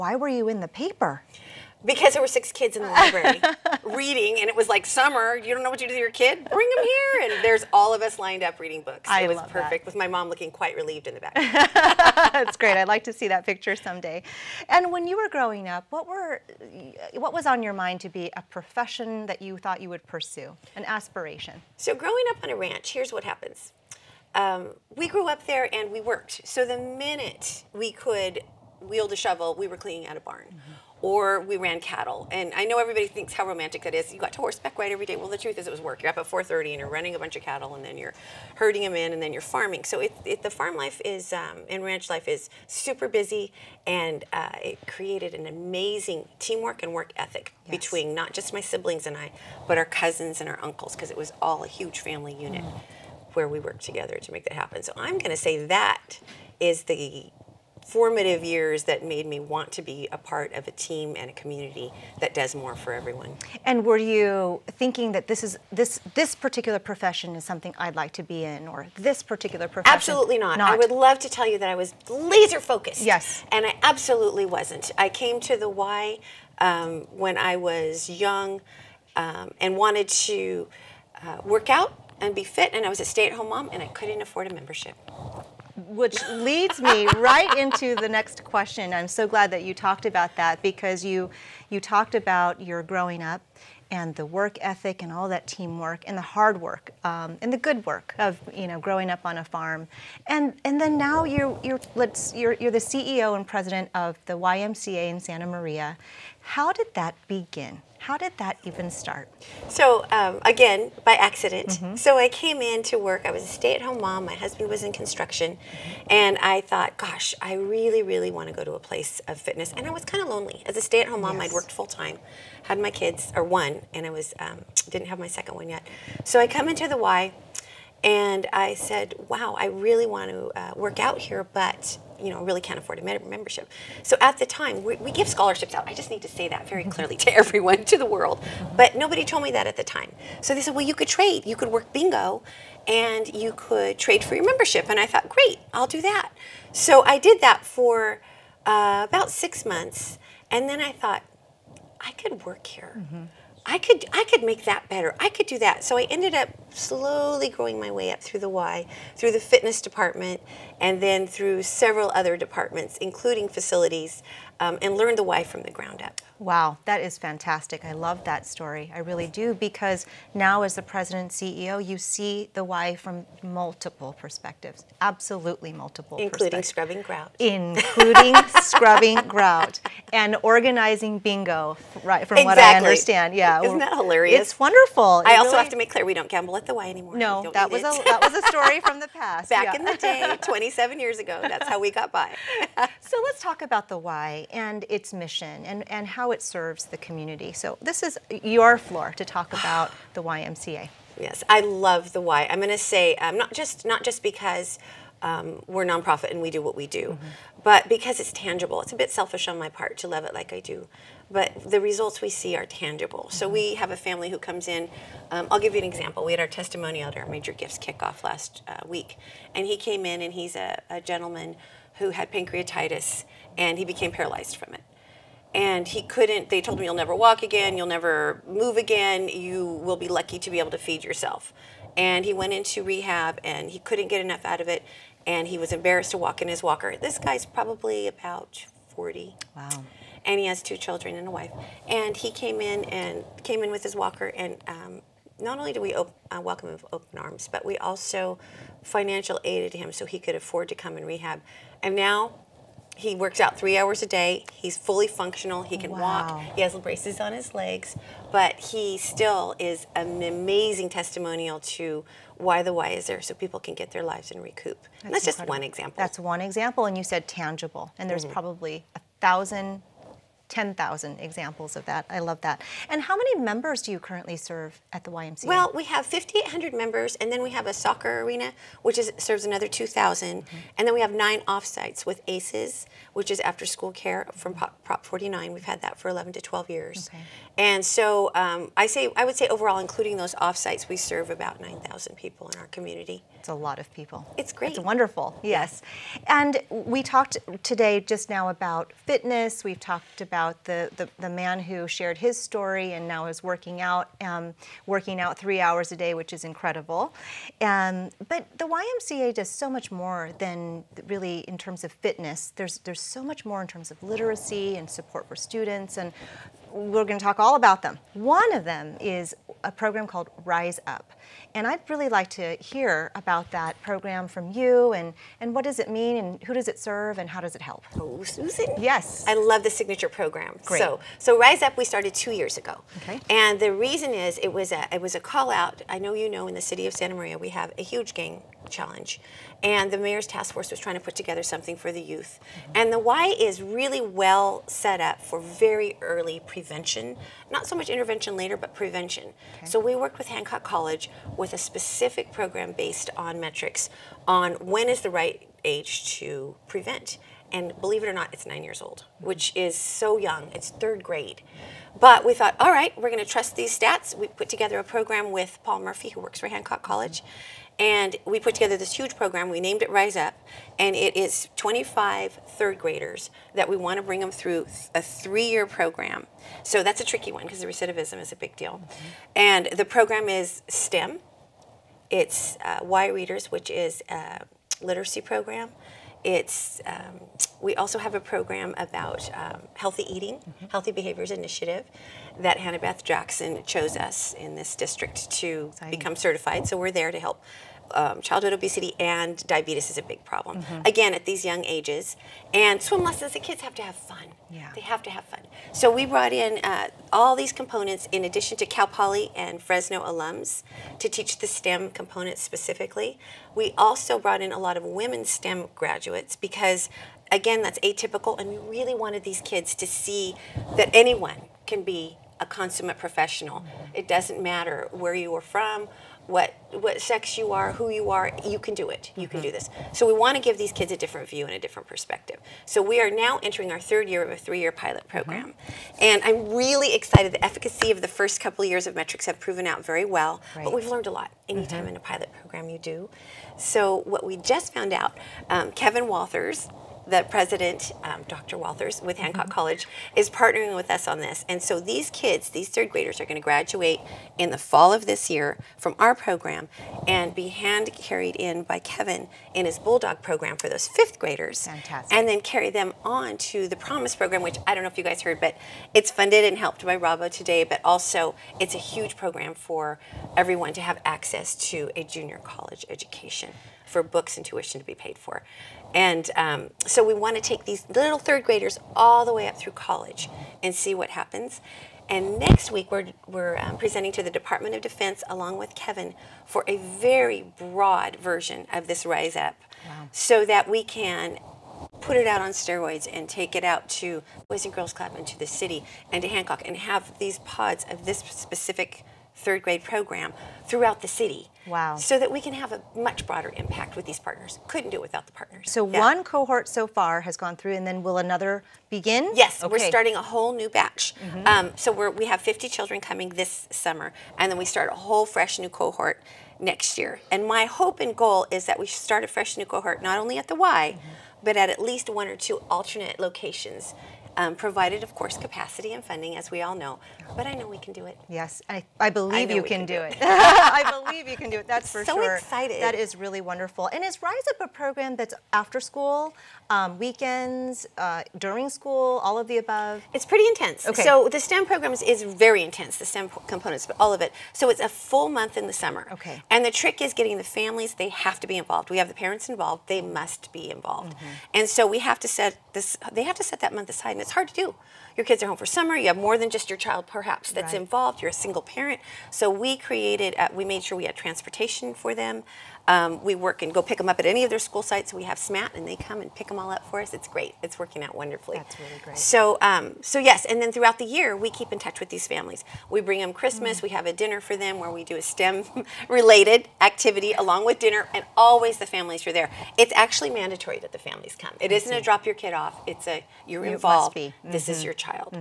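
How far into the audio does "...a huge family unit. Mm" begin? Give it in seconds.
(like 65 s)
51 s.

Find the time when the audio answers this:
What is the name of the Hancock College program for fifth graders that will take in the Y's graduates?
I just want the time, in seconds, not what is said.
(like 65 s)
459 s.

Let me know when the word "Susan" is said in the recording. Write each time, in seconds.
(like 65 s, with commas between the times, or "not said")
328 s.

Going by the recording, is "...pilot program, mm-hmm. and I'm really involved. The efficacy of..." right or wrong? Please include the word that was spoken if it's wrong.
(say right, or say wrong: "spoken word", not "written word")
wrong: "excited", not "involved".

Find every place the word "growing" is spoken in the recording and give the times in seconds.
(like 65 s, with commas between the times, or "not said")
15 s, 21 s, 92 s, 98 s, 157 s.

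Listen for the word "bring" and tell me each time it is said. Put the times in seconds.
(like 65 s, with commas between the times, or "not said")
6 s, 374 s, 573 s.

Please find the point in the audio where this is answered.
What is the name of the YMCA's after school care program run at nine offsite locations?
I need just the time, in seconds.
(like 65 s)
282 s.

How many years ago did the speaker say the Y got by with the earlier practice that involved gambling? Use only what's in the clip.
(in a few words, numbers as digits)
27.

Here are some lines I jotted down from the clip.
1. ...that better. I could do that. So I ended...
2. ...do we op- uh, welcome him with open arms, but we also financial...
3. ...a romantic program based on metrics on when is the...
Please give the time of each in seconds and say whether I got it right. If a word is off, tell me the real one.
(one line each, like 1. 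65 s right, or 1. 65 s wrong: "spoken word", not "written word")
1. 154 s right
2. 245 s right
3. 351 s wrong: "specific", not "romantic".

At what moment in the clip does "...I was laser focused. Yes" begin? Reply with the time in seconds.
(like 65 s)
71 s.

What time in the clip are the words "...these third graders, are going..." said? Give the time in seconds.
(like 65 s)
452 s.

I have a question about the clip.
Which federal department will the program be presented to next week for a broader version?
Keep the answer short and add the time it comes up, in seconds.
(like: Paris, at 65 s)
Department of Defense, at 484 s.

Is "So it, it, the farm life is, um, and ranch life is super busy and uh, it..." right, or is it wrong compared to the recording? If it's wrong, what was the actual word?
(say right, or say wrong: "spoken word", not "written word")
right.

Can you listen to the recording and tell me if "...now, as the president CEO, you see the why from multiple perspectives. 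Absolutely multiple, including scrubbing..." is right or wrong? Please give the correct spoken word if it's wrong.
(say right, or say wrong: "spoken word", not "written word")
right.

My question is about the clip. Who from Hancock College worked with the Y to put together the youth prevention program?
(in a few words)
Paul Murphy.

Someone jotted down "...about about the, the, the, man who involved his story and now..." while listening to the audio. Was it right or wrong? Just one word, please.
wrong.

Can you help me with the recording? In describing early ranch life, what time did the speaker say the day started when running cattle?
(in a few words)
4:30.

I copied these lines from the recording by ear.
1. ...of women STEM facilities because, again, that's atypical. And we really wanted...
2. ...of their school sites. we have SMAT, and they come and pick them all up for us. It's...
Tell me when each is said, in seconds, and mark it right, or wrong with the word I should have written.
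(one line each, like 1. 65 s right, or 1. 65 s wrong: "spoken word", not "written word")
1. 414 s wrong: "graduates", not "facilities"
2. 564 s right.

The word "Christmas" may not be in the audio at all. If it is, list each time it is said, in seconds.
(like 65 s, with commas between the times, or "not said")
573 s.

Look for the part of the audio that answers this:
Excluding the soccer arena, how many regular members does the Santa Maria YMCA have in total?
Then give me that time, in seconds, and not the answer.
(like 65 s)
276 s.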